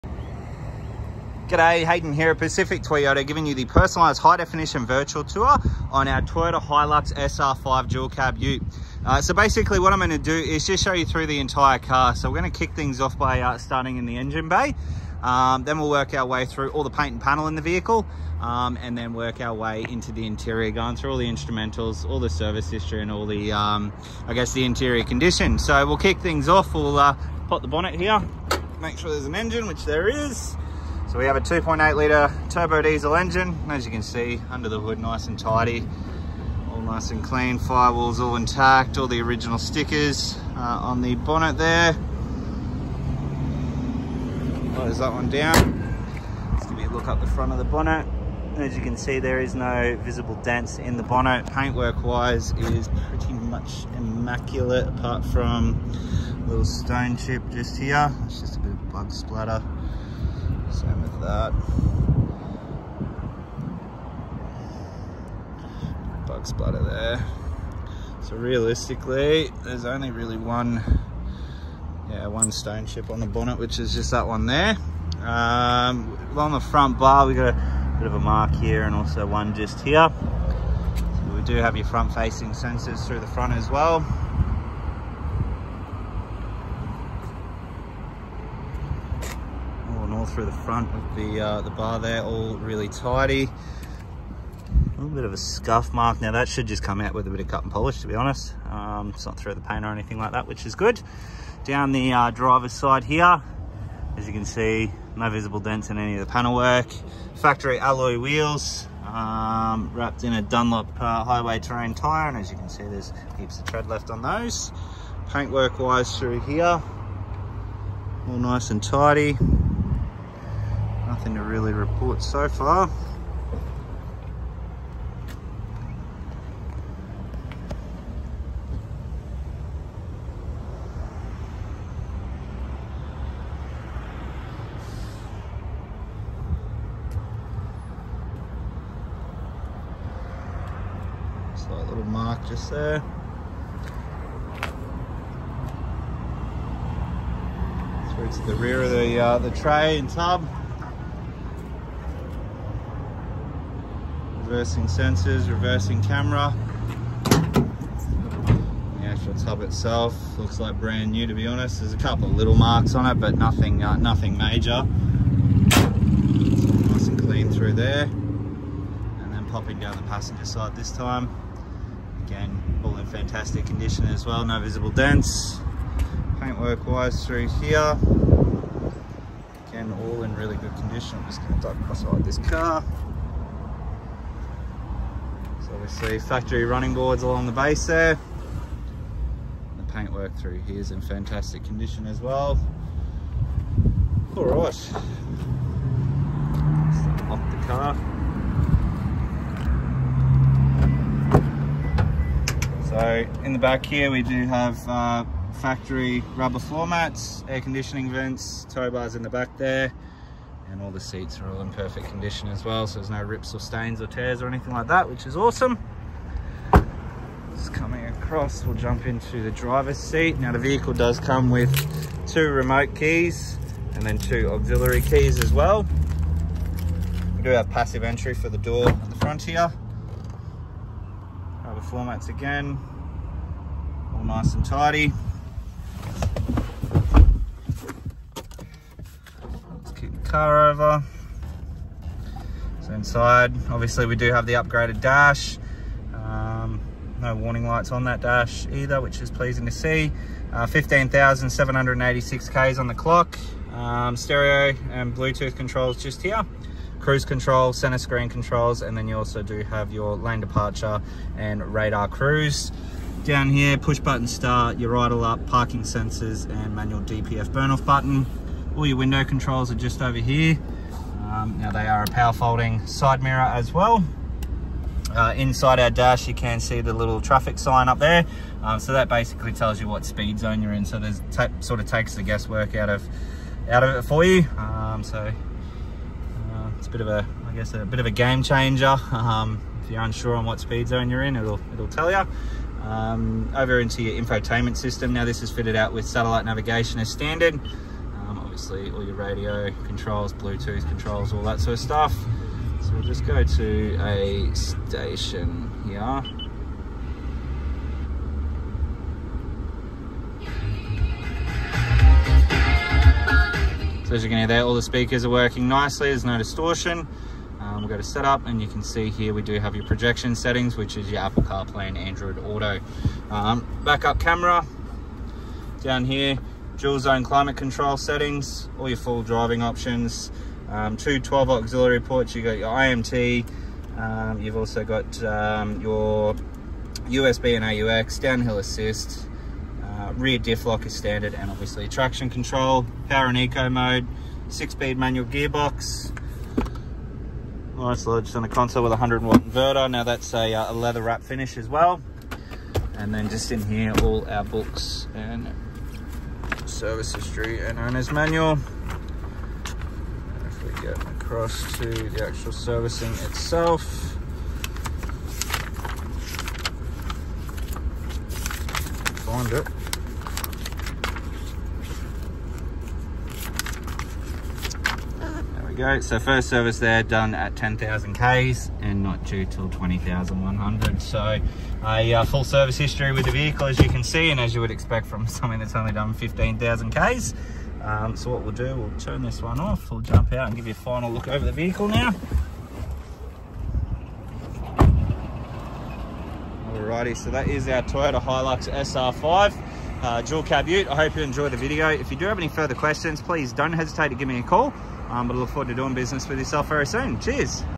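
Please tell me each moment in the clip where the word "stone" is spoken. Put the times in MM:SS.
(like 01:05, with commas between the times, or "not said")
00:56, 01:12.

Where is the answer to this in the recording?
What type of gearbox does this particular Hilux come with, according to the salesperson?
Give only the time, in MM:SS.
05:44.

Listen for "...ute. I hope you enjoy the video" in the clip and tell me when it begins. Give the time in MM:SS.
06:40.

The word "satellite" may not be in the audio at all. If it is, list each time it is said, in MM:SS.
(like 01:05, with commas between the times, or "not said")
04:56.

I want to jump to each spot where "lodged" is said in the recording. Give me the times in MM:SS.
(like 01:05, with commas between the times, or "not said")
05:48.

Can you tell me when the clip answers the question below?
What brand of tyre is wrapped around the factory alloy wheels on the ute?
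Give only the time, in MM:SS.
01:50.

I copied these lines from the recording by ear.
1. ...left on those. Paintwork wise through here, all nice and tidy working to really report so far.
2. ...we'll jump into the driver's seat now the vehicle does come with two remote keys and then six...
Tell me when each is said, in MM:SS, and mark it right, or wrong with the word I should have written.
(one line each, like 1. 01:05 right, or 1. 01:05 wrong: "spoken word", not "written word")
1. 01:53 wrong: "nothing", not "working"
2. 03:38 wrong: "two", not "six".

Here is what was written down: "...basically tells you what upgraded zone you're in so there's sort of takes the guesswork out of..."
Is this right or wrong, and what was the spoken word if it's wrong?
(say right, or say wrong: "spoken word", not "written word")
wrong: "speed", not "upgraded".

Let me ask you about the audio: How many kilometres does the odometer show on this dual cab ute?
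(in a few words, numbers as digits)
15,786.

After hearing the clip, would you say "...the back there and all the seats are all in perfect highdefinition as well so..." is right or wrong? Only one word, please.
wrong.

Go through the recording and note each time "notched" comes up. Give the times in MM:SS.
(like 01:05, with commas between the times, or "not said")
not said.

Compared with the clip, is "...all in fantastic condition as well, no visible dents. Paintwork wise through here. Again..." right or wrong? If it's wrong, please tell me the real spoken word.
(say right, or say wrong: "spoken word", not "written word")
right.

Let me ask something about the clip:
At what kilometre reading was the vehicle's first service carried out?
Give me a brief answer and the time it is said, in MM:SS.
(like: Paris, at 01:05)
10,000 km, at 06:17.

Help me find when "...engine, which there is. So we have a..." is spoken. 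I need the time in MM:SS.
00:29.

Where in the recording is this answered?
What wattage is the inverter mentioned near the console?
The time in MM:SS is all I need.
05:48.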